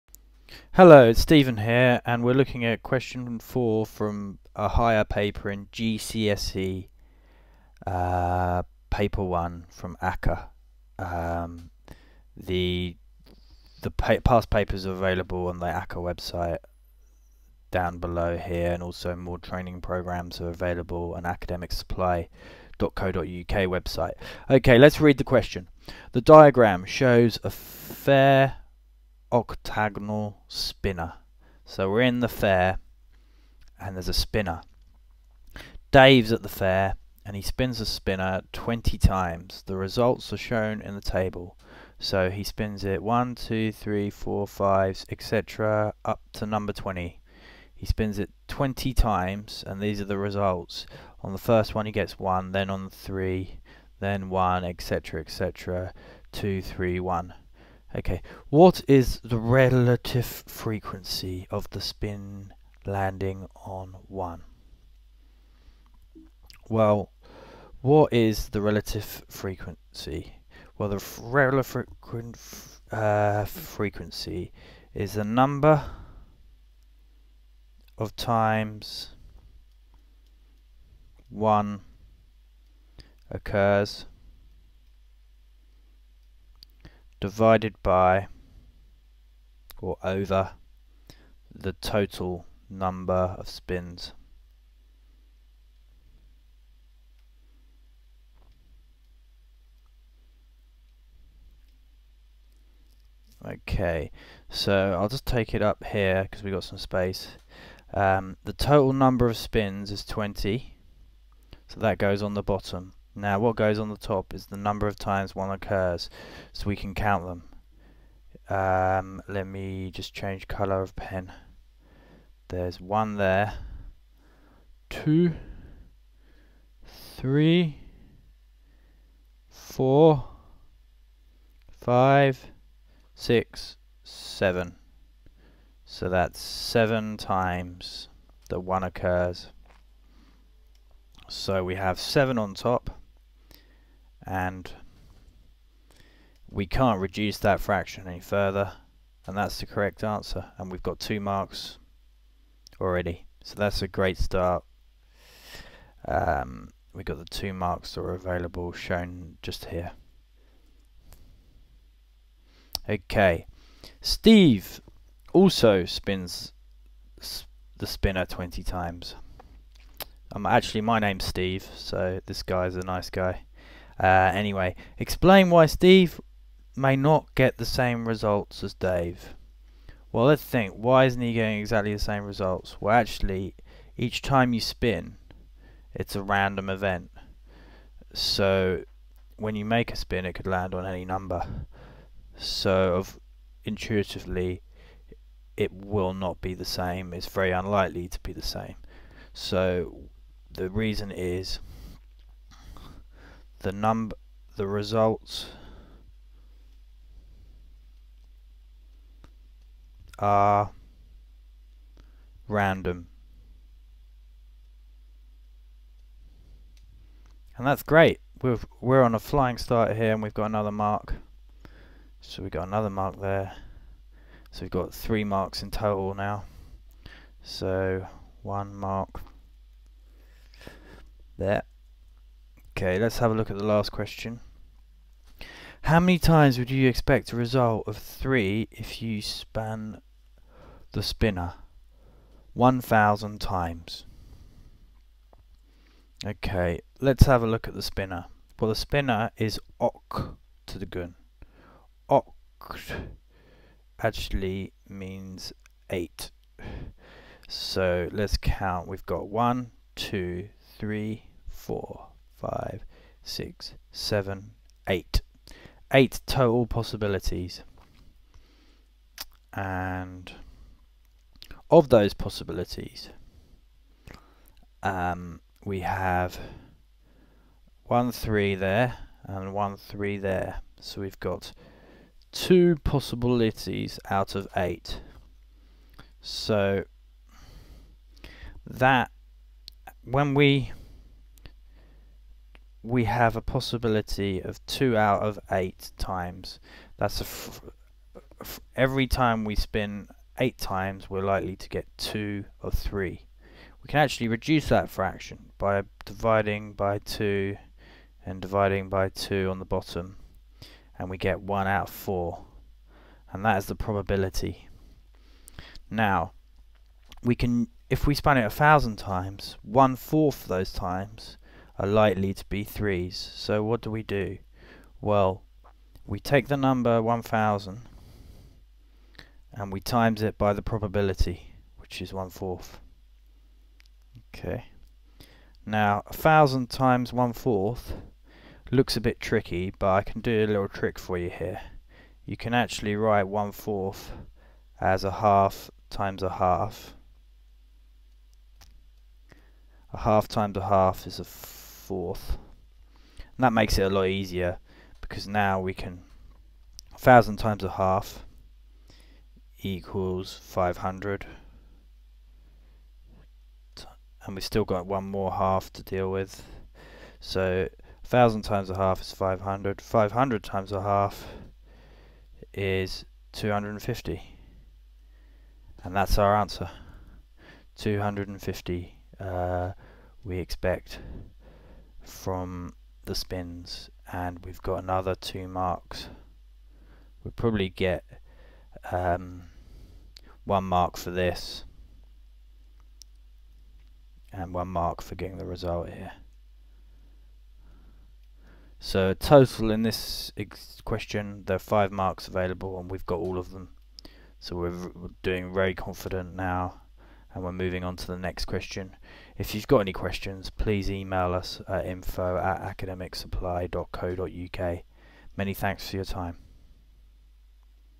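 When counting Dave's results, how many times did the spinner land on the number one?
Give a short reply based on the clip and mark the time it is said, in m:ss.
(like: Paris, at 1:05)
7, at 2:16.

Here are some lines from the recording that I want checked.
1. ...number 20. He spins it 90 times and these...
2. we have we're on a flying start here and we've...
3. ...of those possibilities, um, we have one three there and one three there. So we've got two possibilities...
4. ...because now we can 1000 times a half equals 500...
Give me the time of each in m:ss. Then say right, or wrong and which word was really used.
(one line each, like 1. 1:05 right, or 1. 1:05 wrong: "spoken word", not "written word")
1. 0:46 wrong: "20", not "90"
2. 3:38 right
3. 4:31 right
4. 5:55 right.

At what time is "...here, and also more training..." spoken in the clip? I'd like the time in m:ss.
0:18.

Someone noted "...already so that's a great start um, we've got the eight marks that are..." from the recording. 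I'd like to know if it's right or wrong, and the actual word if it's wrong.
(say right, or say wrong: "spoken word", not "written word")
wrong: "two", not "eight".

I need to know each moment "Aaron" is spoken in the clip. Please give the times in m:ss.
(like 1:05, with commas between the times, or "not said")
not said.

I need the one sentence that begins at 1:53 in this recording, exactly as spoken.
Now what goes on the top is the number of times one occurs, so we can count them.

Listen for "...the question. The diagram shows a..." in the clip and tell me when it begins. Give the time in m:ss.
0:25.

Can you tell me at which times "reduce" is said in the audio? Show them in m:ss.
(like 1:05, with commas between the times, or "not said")
2:27, 5:04.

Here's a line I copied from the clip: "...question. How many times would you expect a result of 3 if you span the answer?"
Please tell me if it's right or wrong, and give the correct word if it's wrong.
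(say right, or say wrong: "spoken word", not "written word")
wrong: "spinner", not "answer".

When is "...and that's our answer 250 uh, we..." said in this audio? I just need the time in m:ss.
6:15.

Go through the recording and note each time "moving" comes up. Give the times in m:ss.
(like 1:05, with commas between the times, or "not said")
6:47.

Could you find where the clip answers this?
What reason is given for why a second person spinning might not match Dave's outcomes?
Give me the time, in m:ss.
3:24.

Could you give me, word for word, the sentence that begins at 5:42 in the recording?
You can actually write 1 fourth as a half times a half.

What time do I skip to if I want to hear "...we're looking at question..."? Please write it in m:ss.
0:02.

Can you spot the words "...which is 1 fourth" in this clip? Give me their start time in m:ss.
5:31.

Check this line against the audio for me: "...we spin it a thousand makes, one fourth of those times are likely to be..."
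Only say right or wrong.
wrong.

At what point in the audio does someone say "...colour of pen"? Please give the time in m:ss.
2:00.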